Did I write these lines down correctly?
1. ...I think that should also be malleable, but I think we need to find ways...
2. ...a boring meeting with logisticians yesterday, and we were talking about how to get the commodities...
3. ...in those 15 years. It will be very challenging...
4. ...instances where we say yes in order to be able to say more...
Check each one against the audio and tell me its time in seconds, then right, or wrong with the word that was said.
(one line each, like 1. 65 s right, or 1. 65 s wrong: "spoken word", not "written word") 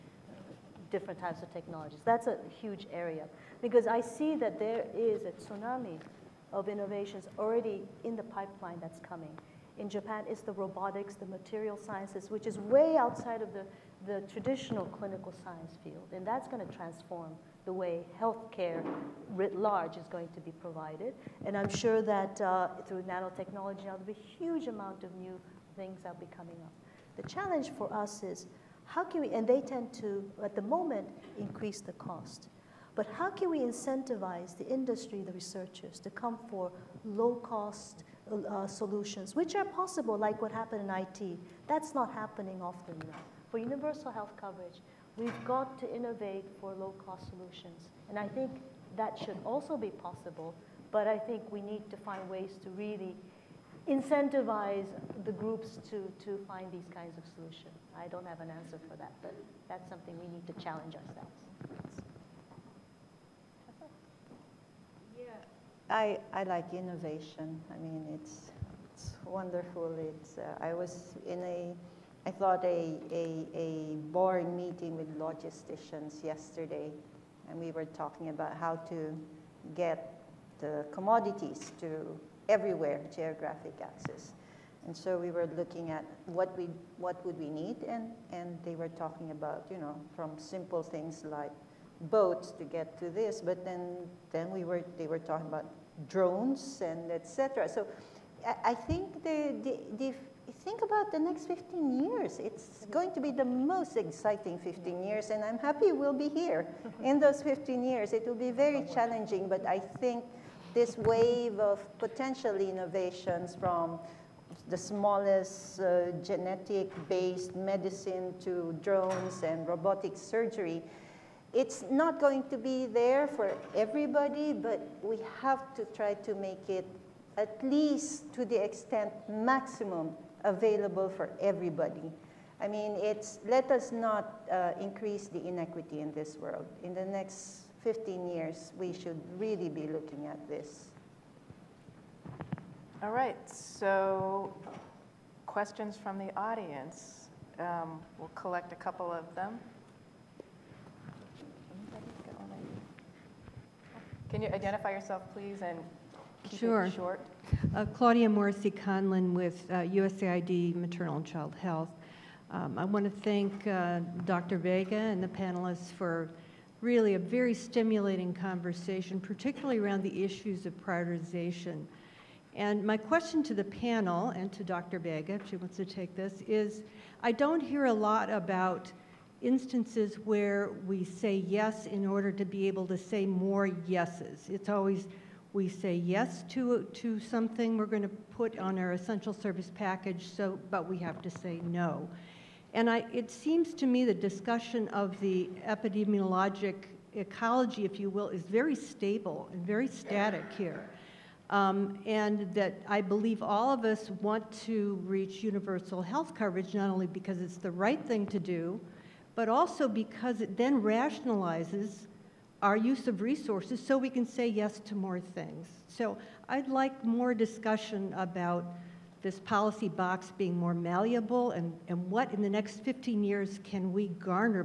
1. 48 s wrong: "possible", not "malleable"
2. 73 s right
3. 107 s right
4. 179 s right.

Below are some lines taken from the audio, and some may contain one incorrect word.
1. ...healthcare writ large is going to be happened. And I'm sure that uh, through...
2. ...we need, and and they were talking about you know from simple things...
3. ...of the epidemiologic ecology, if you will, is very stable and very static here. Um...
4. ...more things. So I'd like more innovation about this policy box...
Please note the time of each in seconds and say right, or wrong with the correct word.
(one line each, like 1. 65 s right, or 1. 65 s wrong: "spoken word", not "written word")
1. 18 s wrong: "provided", not "happened"
2. 87 s right
3. 194 s right
4. 214 s wrong: "discussion", not "innovation".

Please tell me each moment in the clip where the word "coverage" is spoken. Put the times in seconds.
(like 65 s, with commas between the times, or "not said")
44 s, 206 s.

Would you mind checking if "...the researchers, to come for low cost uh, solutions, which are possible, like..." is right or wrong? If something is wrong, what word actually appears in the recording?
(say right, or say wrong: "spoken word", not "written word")
right.